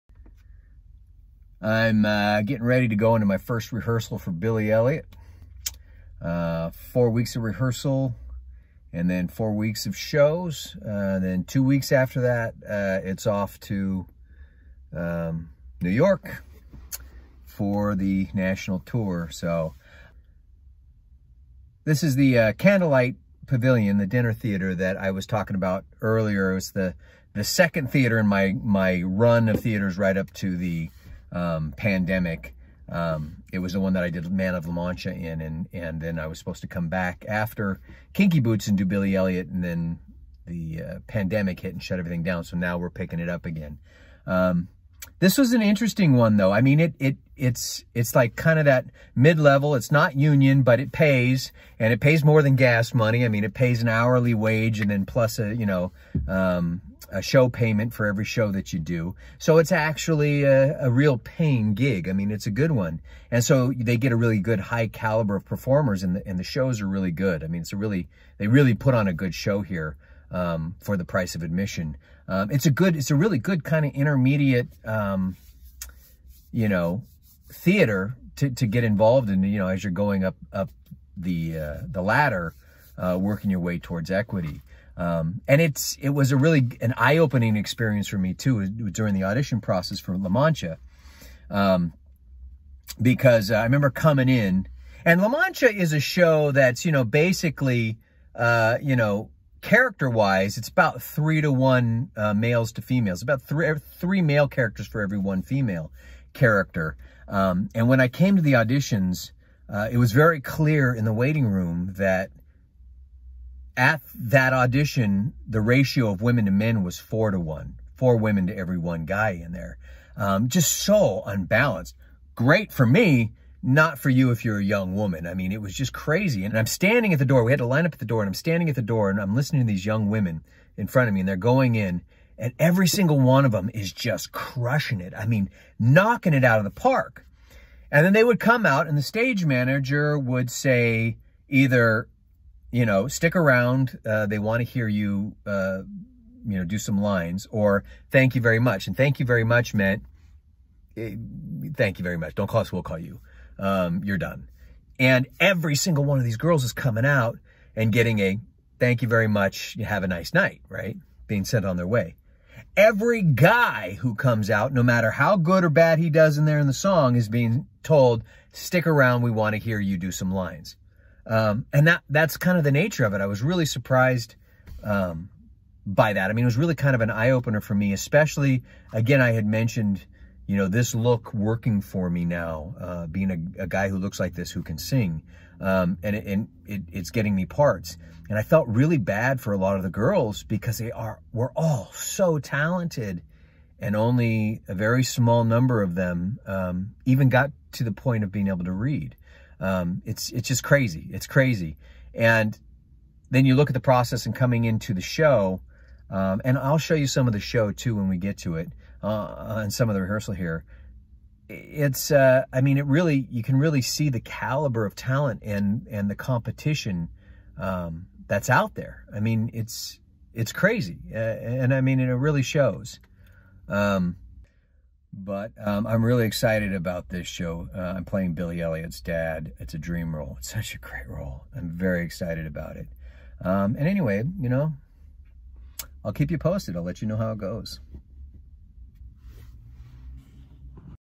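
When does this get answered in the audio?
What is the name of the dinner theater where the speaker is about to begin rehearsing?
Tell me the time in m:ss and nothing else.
0:22.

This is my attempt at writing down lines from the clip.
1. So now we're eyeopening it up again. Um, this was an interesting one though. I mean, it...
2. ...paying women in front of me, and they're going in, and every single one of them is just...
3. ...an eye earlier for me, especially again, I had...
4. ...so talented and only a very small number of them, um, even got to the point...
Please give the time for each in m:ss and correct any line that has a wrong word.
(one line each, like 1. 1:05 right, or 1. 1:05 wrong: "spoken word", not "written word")
1. 0:42 wrong: "picking", not "eyeopening"
2. 2:09 wrong: "young", not "paying"
3. 2:57 wrong: "opener", not "earlier"
4. 3:11 right.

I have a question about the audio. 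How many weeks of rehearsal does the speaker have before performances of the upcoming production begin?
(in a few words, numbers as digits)
4.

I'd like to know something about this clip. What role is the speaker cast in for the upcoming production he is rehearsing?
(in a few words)
Billy Elliot's dad.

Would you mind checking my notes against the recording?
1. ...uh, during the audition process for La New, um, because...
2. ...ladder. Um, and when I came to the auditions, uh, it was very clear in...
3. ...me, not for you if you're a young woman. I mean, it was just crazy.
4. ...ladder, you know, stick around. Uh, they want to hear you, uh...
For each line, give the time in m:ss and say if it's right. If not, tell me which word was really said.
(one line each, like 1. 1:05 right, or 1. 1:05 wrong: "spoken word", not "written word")
1. 1:28 wrong: "Mancha", not "New"
2. 1:46 wrong: "character", not "ladder"
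3. 2:02 right
4. 2:21 wrong: "either", not "ladder".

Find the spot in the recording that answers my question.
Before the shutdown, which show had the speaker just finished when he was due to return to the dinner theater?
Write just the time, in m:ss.
0:38.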